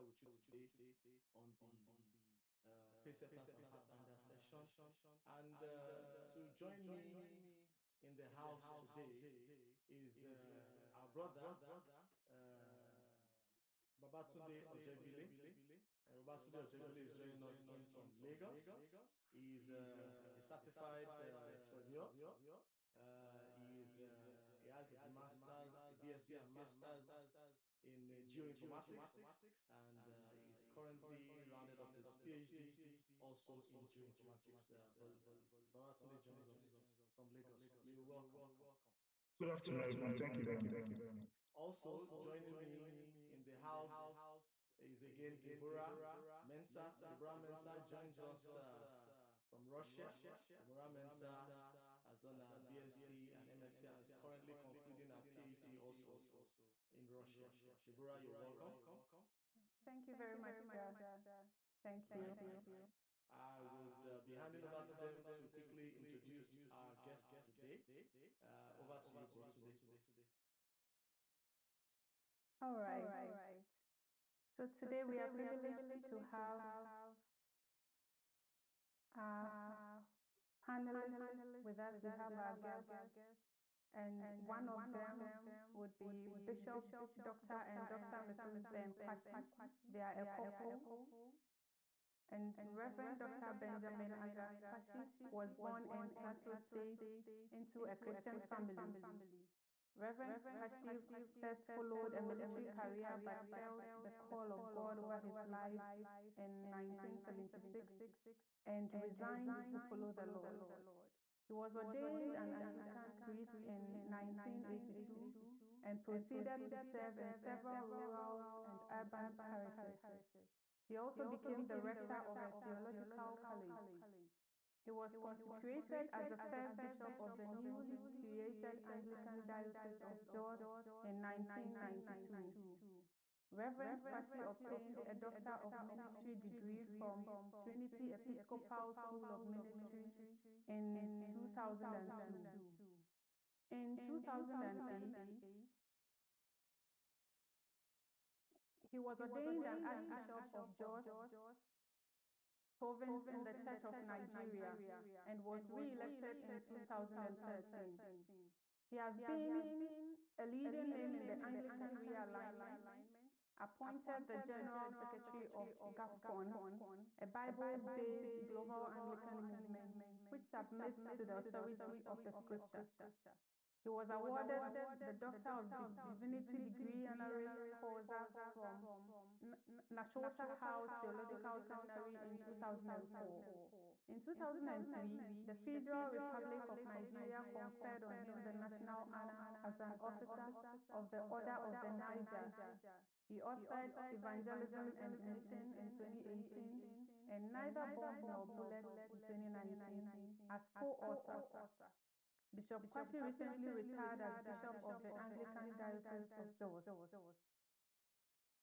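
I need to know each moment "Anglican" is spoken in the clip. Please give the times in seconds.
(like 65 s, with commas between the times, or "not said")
112 s, 128 s, 161 s, 169 s, 205 s.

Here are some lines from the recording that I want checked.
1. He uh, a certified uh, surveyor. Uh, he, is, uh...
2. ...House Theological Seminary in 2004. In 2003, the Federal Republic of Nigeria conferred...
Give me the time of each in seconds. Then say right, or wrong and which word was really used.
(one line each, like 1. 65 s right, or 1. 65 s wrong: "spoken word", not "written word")
1. 19 s right
2. 180 s right.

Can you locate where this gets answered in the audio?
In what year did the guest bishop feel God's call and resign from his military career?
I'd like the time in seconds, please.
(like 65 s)
107 s.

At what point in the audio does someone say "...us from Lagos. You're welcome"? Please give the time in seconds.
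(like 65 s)
36 s.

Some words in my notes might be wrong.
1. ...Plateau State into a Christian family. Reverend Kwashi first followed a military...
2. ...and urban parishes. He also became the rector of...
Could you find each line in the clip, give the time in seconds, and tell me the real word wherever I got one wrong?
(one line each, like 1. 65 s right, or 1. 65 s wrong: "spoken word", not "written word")
1. 96 s right
2. 118 s right.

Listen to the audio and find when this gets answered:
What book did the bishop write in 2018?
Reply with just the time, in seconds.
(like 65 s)
194 s.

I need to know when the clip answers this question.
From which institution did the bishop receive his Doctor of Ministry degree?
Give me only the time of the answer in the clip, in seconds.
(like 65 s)
137 s.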